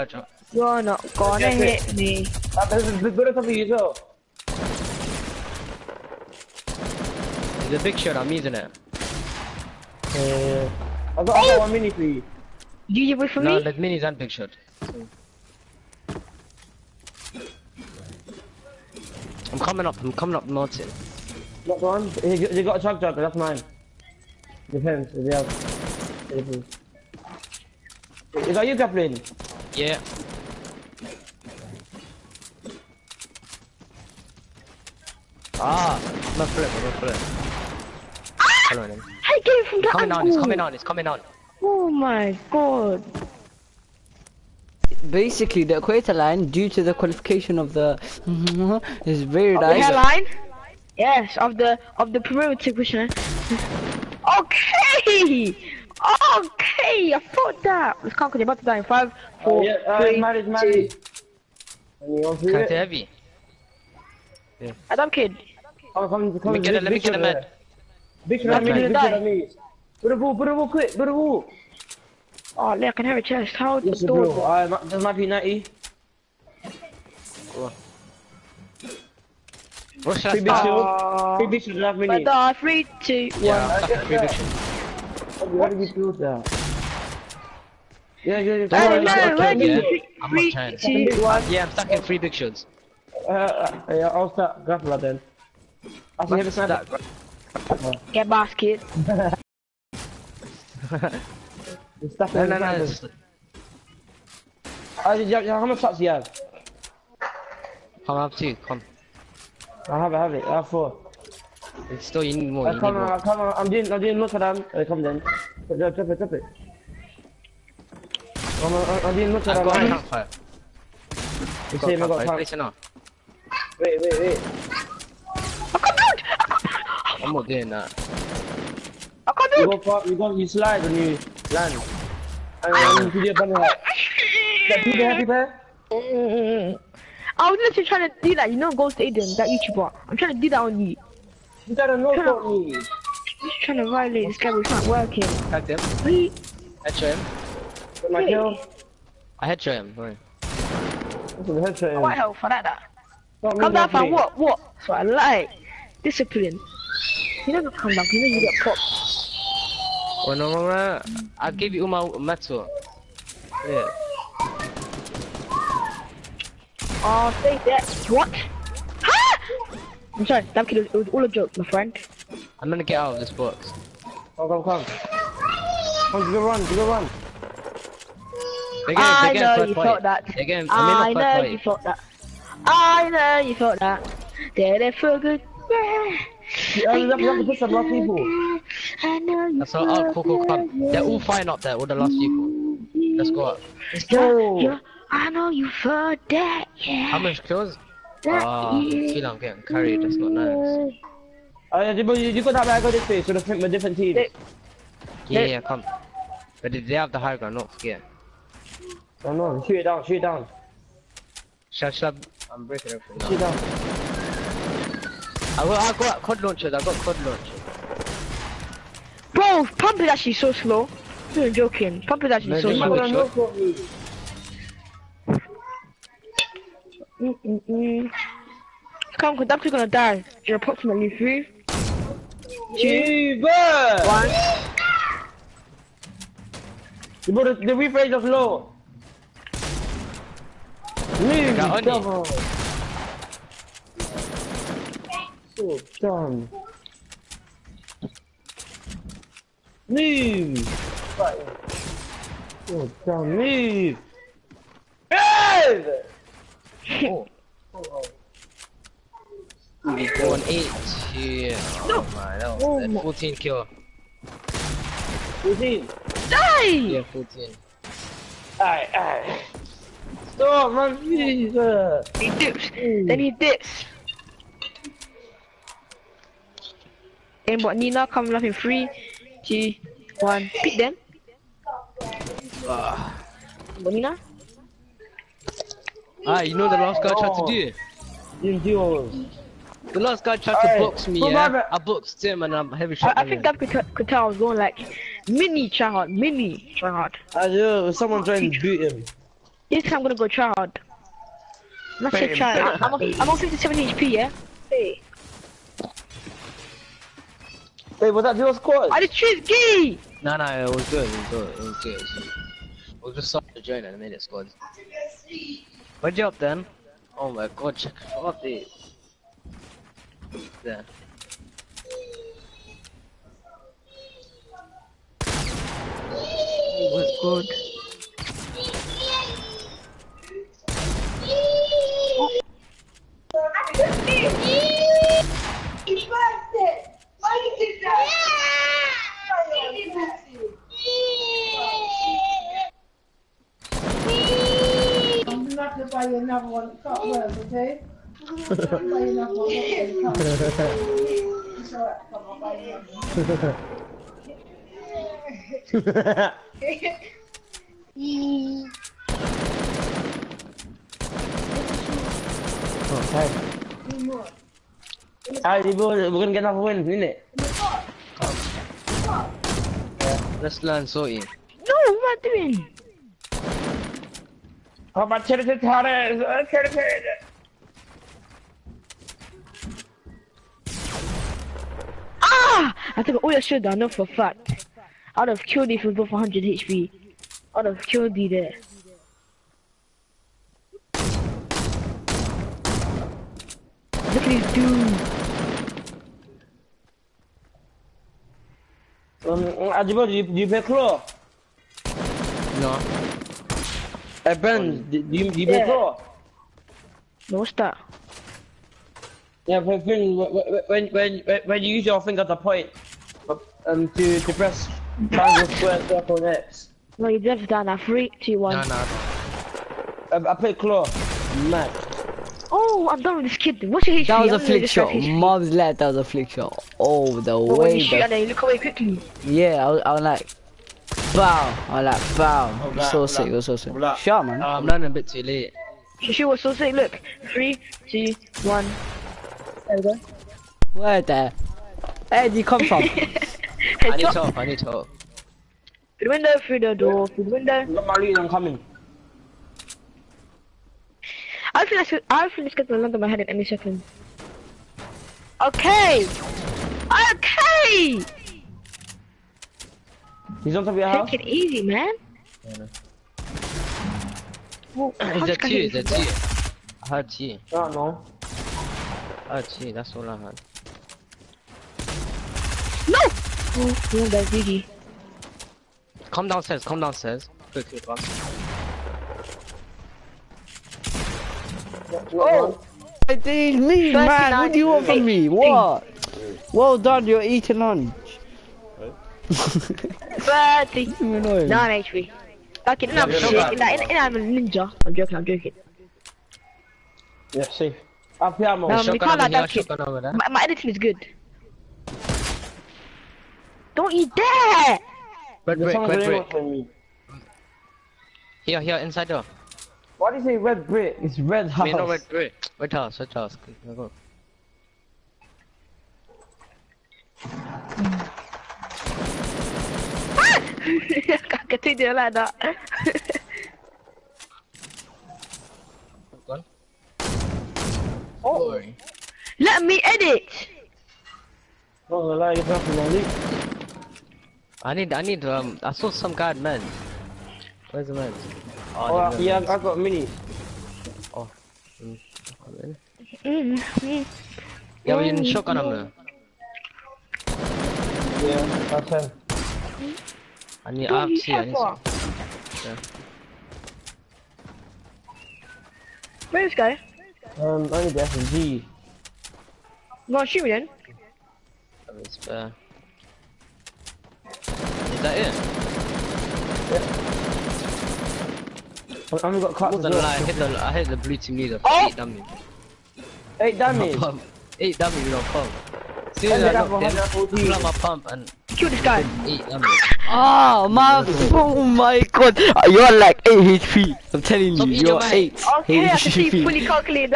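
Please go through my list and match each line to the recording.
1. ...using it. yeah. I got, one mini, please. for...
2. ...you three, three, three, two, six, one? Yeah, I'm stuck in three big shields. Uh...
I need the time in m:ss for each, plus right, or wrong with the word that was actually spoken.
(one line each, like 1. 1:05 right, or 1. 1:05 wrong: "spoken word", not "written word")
1. 0:08 right
2. 1:29 wrong: "two", not "six".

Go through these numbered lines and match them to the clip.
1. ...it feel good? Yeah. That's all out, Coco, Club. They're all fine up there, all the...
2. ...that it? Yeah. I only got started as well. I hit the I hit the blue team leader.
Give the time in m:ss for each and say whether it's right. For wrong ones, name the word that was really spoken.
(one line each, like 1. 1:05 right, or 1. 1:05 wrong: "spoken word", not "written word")
1. 3:04 right
2. 9:25 wrong: "cracked", not "started".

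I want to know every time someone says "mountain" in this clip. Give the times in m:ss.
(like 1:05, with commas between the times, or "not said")
0:20.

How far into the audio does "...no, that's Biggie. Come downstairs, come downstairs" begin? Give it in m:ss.
7:53.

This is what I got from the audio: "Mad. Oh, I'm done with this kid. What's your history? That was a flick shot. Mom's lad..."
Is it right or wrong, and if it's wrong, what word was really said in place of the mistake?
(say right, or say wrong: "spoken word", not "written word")
right.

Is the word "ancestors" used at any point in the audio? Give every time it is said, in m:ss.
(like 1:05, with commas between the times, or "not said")
not said.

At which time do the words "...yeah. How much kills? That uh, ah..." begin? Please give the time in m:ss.
3:16.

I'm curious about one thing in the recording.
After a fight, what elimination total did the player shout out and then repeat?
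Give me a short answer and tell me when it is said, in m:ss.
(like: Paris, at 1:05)
14, at 4:23.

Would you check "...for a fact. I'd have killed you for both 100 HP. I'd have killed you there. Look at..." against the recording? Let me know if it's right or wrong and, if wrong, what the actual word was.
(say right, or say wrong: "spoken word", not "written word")
right.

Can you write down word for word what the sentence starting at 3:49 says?
Come, cause I'm gonna die You're approximately Two three, two, one.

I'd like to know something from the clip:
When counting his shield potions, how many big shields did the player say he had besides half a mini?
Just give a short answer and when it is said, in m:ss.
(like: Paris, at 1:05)
3, at 1:21.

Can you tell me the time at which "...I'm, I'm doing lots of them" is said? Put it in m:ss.
1:58.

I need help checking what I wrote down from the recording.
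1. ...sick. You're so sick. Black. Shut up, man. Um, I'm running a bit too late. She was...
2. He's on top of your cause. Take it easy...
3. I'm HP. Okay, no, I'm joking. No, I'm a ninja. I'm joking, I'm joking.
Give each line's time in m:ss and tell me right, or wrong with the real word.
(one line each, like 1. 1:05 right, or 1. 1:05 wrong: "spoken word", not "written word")
1. 7:13 right
2. 7:40 wrong: "house", not "cause"
3. 8:11 right.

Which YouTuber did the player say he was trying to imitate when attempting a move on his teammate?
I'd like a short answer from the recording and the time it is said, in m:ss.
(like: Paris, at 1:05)
Ghost Aydan, at 2:18.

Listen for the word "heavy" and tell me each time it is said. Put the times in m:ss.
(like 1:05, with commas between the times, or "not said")
1:02, 4:52.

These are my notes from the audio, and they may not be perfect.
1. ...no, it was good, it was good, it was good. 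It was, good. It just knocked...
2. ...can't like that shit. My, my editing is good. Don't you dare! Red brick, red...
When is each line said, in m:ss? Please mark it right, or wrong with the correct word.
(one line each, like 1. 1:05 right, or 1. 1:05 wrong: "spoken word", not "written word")
1. 5:10 wrong: "started", not "knocked"
2. 8:18 right.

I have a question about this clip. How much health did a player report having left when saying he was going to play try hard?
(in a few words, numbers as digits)
57 HP.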